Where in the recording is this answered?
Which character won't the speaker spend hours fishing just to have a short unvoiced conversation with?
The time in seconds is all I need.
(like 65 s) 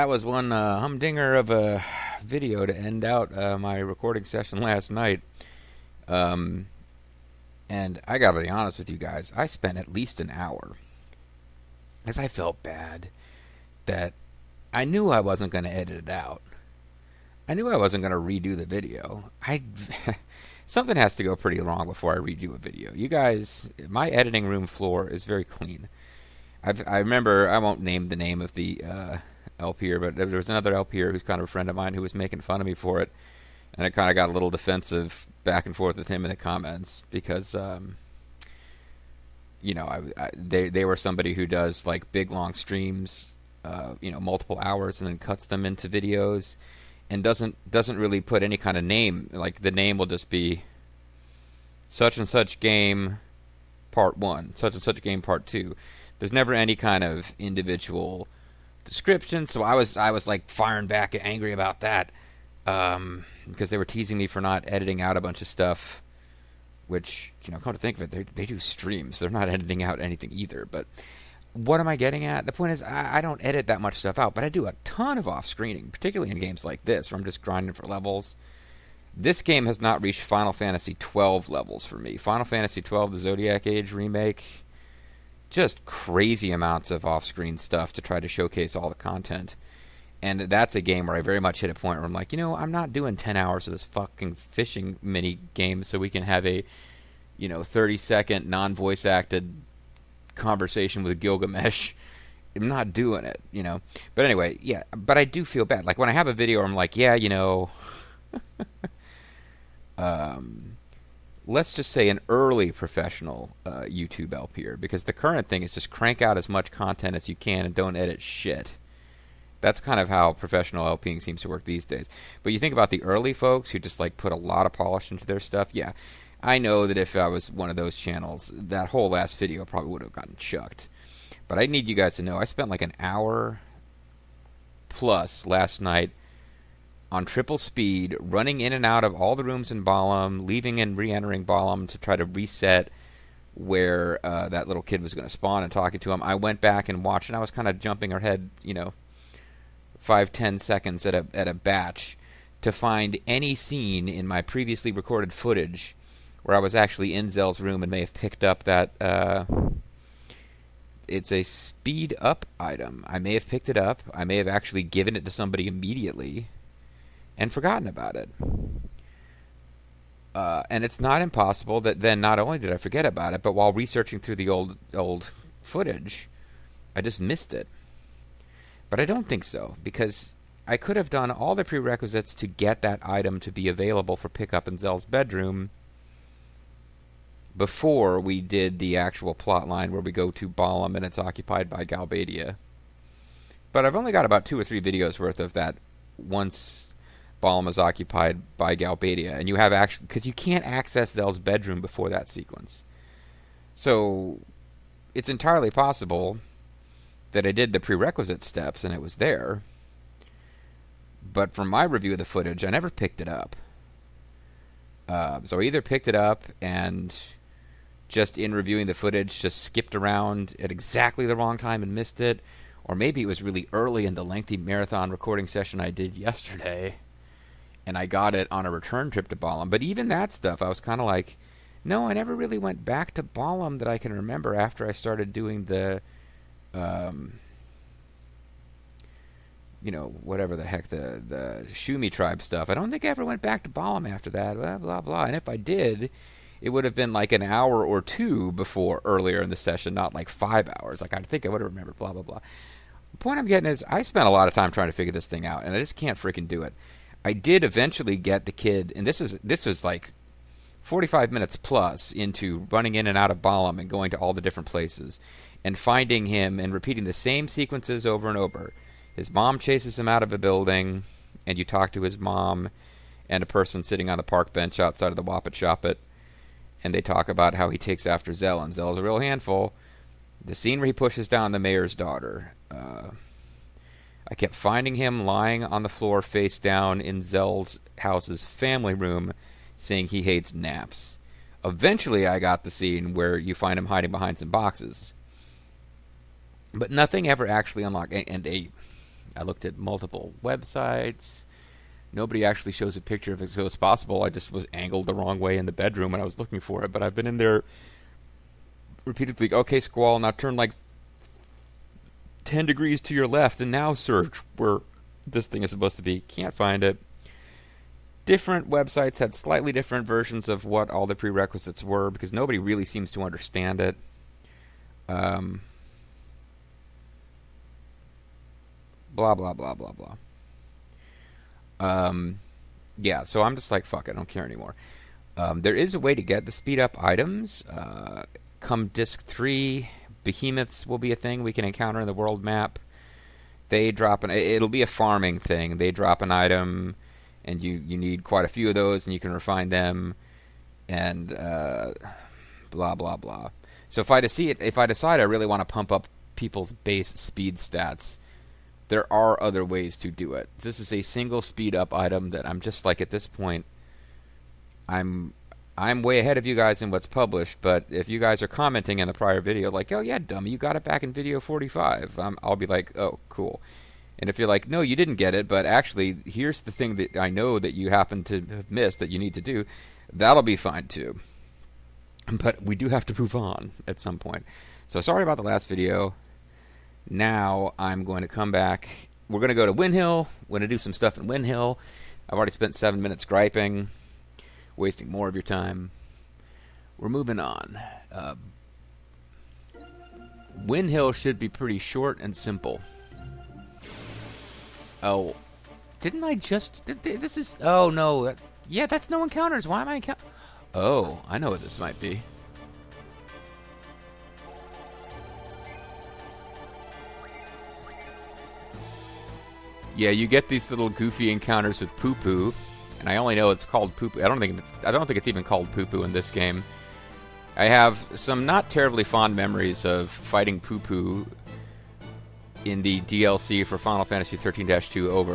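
101 s.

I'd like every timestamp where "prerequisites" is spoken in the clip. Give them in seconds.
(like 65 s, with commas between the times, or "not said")
181 s, 207 s, 321 s.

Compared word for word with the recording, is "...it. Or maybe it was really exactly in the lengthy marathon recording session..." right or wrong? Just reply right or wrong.
wrong.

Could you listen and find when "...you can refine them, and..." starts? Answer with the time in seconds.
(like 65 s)
349 s.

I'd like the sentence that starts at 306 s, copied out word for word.
But I've been in there repeatedly.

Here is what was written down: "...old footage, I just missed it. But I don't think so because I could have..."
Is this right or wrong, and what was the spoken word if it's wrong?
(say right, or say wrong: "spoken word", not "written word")
right.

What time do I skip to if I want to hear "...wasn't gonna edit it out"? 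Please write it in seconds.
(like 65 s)
15 s.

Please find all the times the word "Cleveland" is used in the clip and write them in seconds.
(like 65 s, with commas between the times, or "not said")
not said.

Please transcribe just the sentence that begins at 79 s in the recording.
This game has not reached Final Fantasy twelve levels for me.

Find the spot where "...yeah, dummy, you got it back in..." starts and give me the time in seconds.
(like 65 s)
370 s.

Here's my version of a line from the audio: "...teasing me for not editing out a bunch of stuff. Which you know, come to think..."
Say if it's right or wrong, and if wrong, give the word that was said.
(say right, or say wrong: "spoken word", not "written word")
right.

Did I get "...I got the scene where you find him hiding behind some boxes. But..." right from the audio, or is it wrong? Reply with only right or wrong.
right.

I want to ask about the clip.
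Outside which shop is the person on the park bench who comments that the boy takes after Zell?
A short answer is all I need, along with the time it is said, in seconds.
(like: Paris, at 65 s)
Wapit Shop, at 275 s.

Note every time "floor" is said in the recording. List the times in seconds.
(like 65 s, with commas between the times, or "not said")
24 s, 285 s.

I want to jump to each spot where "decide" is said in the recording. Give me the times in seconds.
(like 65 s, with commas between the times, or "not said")
354 s.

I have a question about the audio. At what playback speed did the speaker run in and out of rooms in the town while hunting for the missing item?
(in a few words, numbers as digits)
triple speed.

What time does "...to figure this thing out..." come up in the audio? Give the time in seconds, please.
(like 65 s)
254 s.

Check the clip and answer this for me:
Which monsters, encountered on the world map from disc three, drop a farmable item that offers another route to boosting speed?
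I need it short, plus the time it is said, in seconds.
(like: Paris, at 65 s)
behemoths, at 340 s.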